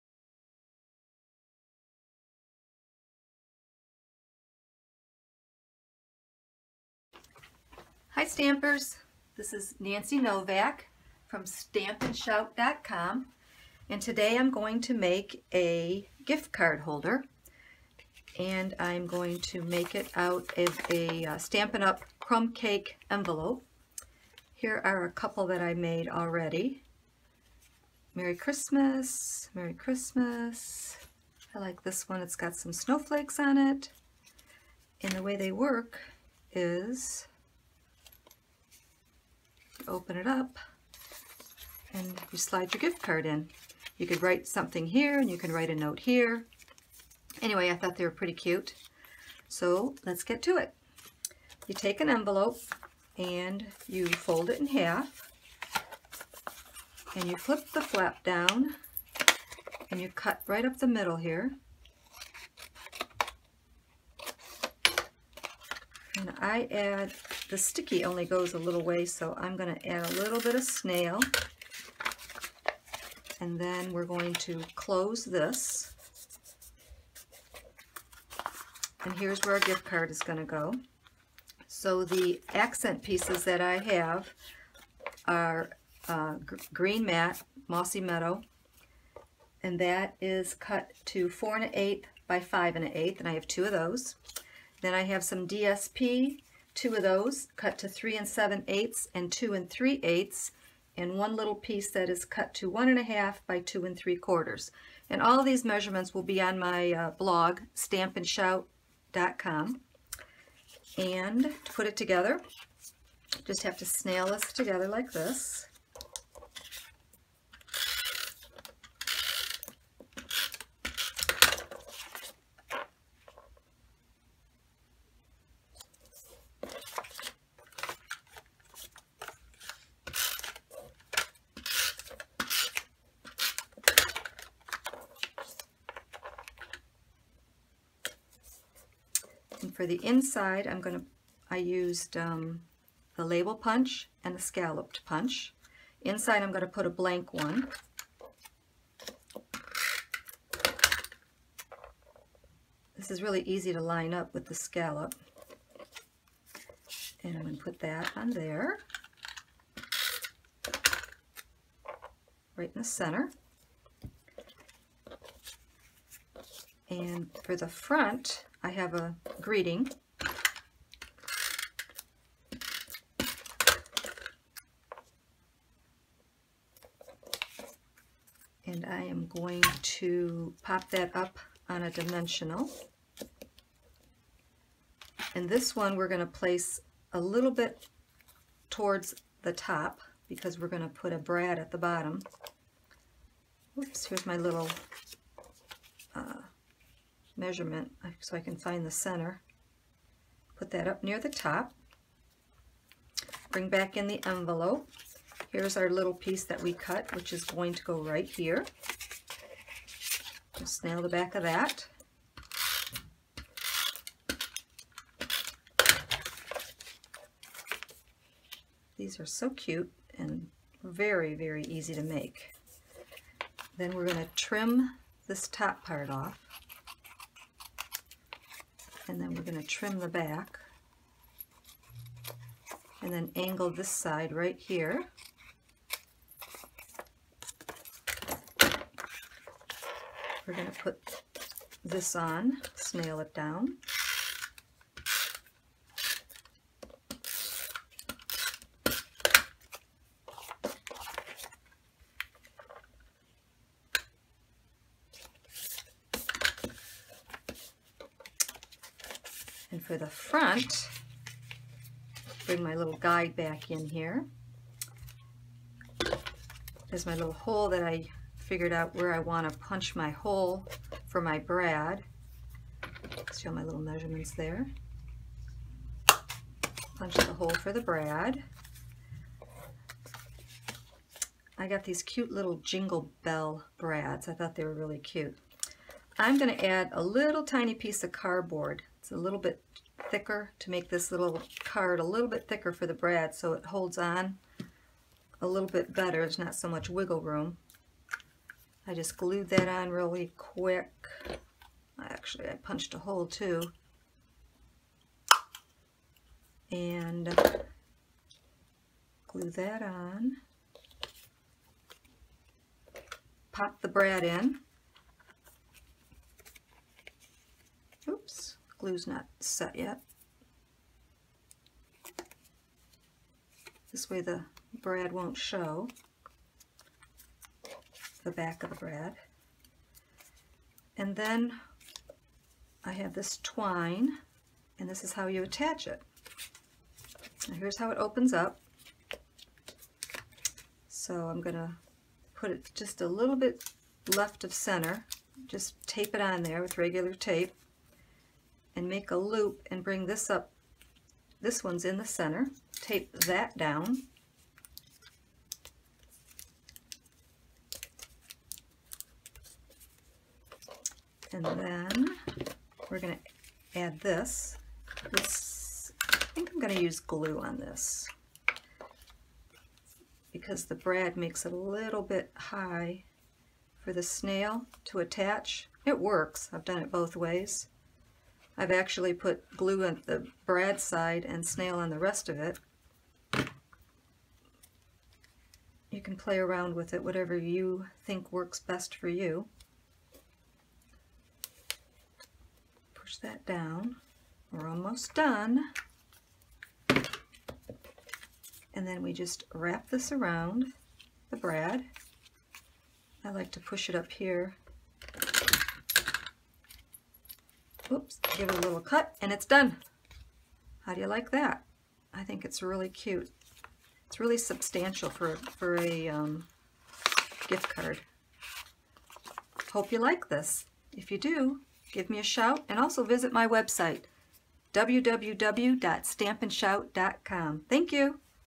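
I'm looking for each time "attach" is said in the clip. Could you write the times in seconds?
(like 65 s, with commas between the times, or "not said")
335 s, 374 s.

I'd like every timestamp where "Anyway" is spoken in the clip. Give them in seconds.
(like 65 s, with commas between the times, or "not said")
47 s.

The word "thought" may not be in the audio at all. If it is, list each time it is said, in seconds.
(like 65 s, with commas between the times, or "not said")
47 s, 284 s.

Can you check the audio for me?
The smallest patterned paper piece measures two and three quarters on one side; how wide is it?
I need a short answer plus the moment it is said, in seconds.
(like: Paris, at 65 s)
1 1/2, at 102 s.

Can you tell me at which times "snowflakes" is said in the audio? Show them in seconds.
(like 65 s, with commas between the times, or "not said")
32 s.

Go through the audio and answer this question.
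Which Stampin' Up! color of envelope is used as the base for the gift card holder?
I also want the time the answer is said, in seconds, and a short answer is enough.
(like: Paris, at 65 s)
Crumb cake, at 22 s.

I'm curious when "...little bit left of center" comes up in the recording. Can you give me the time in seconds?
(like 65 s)
343 s.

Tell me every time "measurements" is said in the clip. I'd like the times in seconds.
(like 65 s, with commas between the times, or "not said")
105 s, 197 s, 273 s.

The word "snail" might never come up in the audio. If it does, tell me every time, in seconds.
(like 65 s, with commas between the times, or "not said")
70 s, 113 s, 242 s, 374 s, 381 s.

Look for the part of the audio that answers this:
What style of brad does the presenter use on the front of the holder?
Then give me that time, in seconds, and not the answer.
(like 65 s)
282 s.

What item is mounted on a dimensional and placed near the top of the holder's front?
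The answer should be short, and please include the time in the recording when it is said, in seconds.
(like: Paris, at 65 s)
A greeting, at 168 s.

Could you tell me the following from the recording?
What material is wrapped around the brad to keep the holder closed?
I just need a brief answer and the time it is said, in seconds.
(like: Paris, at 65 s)
Twine, at 333 s.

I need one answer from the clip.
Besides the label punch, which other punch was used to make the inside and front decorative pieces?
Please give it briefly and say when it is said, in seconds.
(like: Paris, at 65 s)
Scalloped punch, at 144 s.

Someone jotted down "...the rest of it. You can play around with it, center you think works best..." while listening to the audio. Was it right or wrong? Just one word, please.
wrong.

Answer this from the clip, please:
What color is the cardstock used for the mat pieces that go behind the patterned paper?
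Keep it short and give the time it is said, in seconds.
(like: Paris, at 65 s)
Mossy meadow, at 87 s.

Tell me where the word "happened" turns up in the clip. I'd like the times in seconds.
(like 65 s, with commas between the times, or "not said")
not said.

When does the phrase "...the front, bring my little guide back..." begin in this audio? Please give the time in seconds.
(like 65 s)
259 s.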